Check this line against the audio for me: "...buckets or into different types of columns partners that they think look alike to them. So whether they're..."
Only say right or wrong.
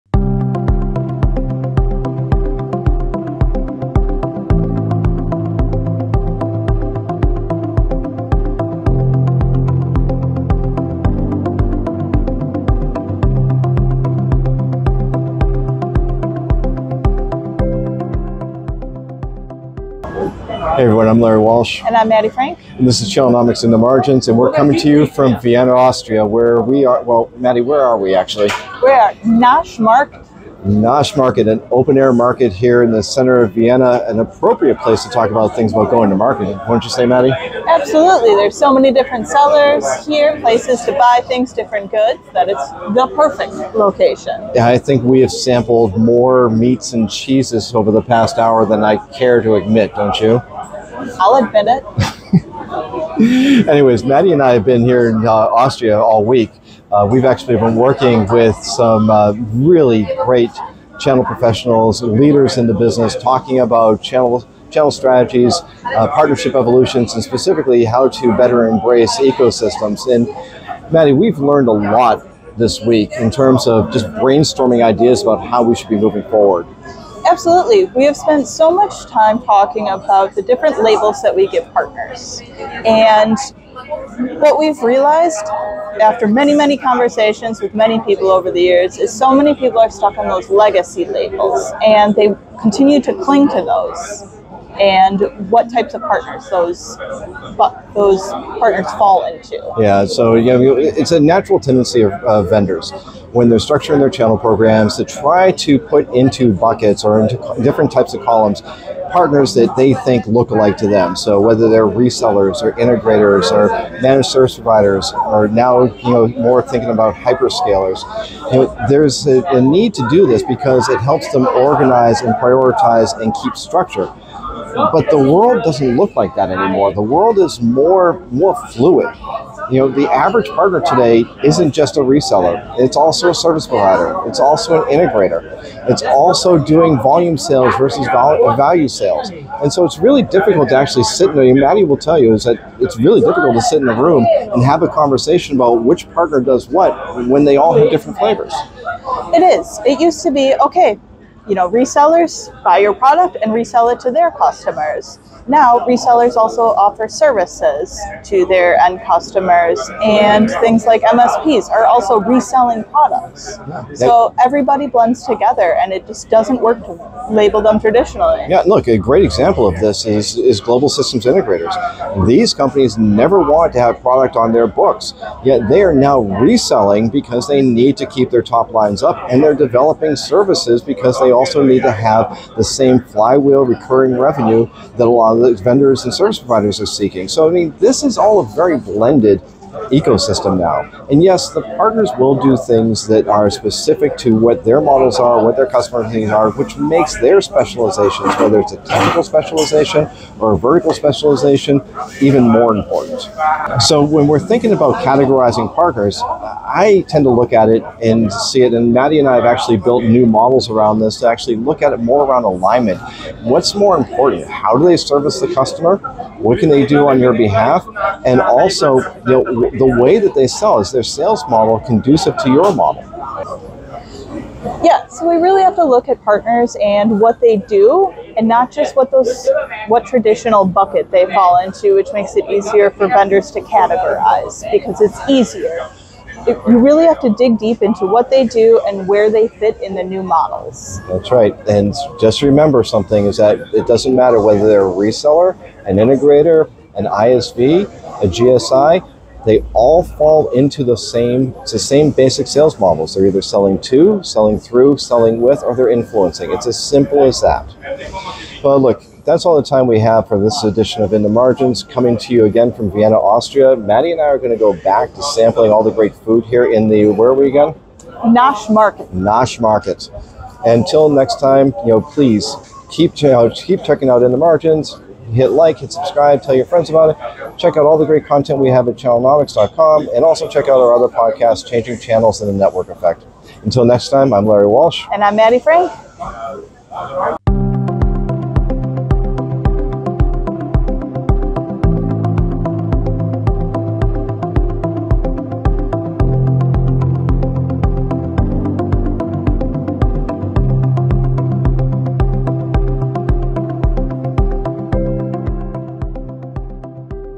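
right.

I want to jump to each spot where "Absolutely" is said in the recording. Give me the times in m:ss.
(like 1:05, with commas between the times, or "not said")
0:37, 1:17.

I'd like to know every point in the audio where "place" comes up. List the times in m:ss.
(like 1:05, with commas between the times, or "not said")
0:34, 0:40.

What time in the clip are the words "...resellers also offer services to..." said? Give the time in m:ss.
2:35.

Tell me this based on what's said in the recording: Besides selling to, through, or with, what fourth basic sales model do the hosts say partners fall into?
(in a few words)
Influencing.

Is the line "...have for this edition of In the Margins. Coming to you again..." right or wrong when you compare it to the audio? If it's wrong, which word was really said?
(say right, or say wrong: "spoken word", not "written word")
right.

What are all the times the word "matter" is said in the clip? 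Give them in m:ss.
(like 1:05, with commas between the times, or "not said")
4:04.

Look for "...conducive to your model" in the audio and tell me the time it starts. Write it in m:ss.
3:41.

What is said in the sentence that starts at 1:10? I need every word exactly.
And Maddie, we've learned a lot this week in terms of just brainstorming ideas about how we should be moving forward.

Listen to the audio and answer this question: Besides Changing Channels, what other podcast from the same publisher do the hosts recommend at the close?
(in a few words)
The Network Effect.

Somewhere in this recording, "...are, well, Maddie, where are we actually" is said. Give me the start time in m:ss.
0:26.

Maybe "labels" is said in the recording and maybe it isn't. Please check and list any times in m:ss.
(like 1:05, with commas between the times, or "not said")
1:20, 1:31, 2:47.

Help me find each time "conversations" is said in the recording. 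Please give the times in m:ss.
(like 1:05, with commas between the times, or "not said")
1:26, 2:24.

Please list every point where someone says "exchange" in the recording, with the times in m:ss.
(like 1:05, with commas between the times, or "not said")
not said.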